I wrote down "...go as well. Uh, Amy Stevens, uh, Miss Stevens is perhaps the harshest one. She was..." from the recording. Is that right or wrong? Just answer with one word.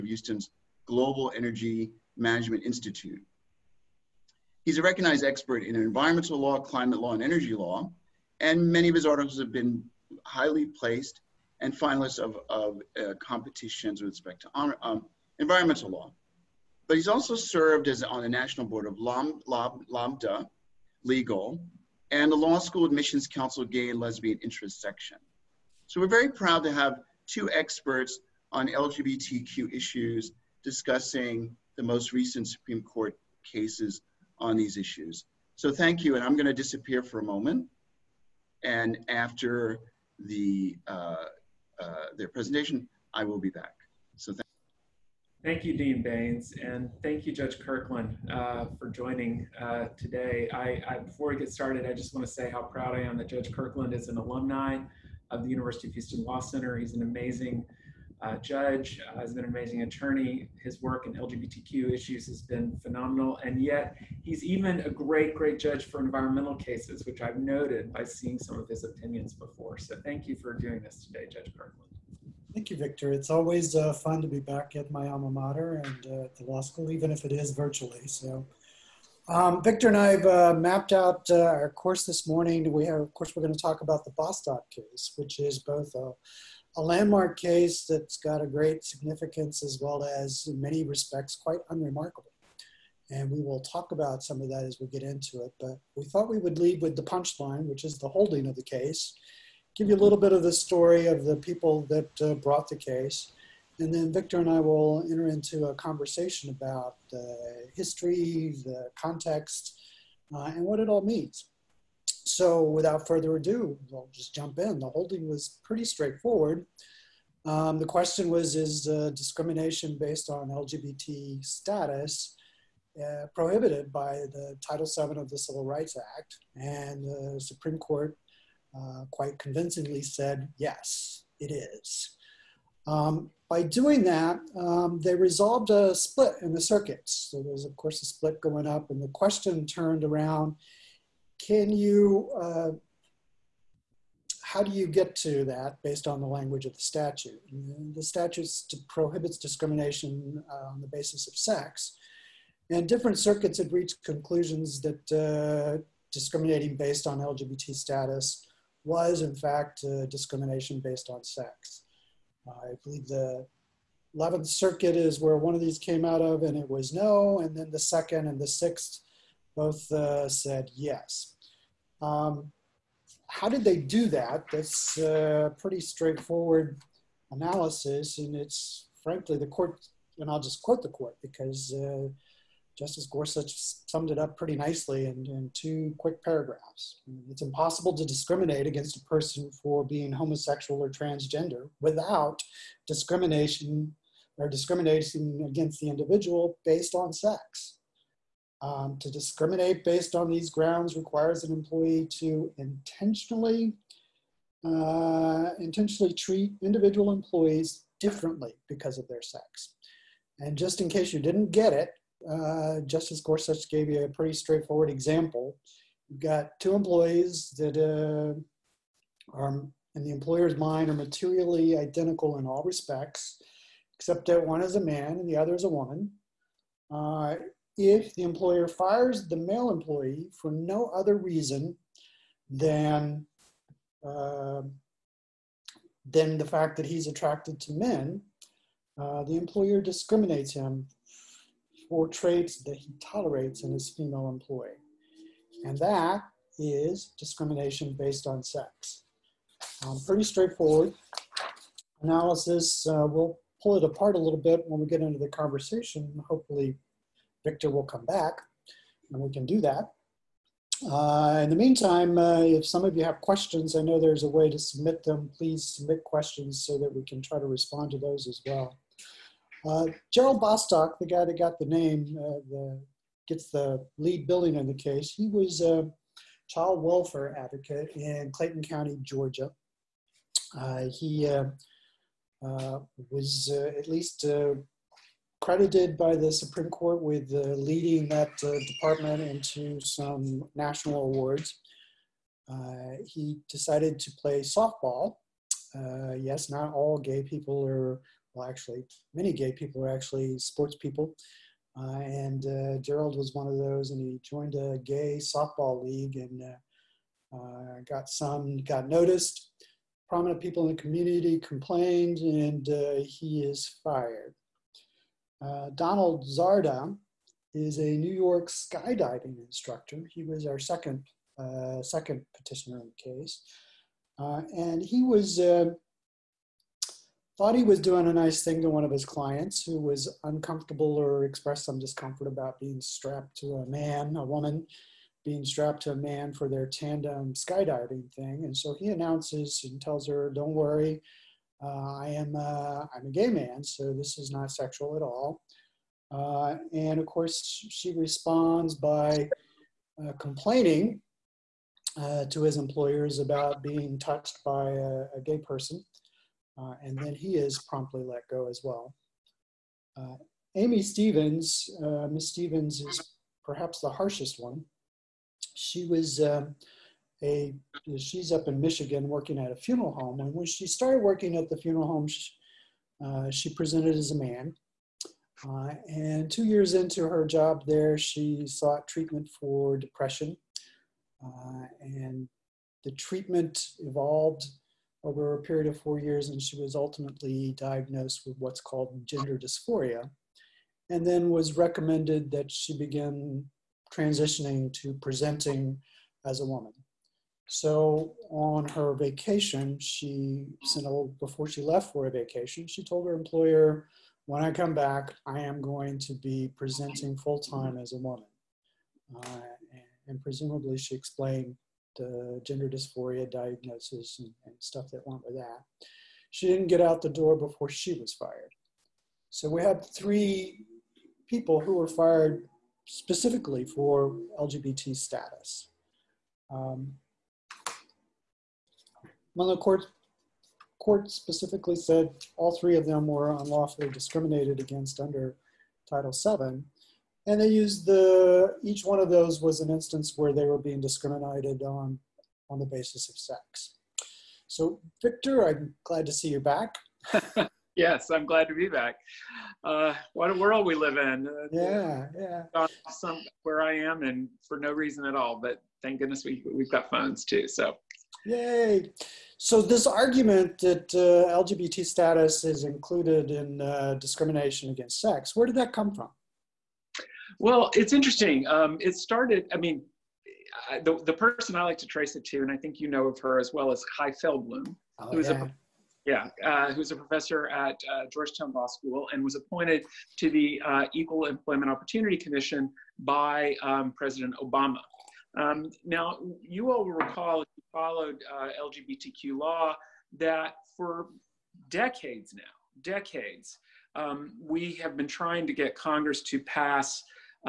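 right.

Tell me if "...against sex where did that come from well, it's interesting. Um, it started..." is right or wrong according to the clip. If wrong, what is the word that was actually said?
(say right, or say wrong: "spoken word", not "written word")
right.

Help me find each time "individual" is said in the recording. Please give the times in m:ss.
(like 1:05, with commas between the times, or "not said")
3:15, 3:26.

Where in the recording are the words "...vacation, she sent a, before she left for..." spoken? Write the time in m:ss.
6:38.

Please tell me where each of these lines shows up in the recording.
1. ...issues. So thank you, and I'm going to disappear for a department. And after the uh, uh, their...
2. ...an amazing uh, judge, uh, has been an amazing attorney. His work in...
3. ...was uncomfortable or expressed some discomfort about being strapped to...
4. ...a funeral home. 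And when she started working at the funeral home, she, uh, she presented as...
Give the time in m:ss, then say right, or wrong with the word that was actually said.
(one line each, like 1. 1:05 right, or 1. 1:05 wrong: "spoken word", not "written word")
1. 0:34 wrong: "moment", not "department"
2. 0:56 right
3. 5:29 right
4. 6:09 right.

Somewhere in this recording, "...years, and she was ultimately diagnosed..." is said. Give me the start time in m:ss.
6:25.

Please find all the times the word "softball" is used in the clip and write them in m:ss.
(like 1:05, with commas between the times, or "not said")
4:54, 5:05.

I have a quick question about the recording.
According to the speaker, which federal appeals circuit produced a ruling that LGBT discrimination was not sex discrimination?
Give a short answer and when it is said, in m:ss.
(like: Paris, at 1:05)
11th Circuit, at 2:44.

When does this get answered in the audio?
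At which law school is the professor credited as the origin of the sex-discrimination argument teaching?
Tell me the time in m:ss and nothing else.
7:58.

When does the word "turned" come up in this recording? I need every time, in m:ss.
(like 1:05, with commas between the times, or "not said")
2:19.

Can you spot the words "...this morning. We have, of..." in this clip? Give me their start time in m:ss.
1:22.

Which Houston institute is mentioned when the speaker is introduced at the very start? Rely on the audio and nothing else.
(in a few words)
Global Energy Management Institute.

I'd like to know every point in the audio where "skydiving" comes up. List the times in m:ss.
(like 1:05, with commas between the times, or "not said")
5:18, 5:37.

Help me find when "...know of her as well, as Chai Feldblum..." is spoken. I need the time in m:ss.
7:52.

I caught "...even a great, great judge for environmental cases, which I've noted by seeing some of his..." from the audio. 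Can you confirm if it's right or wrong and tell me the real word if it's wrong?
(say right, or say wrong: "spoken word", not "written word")
right.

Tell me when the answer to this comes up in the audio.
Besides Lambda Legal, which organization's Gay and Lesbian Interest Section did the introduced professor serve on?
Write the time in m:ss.
0:22.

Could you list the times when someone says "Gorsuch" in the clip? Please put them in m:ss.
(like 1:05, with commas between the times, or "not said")
3:03, 3:33.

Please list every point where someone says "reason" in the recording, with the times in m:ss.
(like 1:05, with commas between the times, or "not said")
3:51, 7:34.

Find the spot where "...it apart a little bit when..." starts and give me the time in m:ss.
4:13.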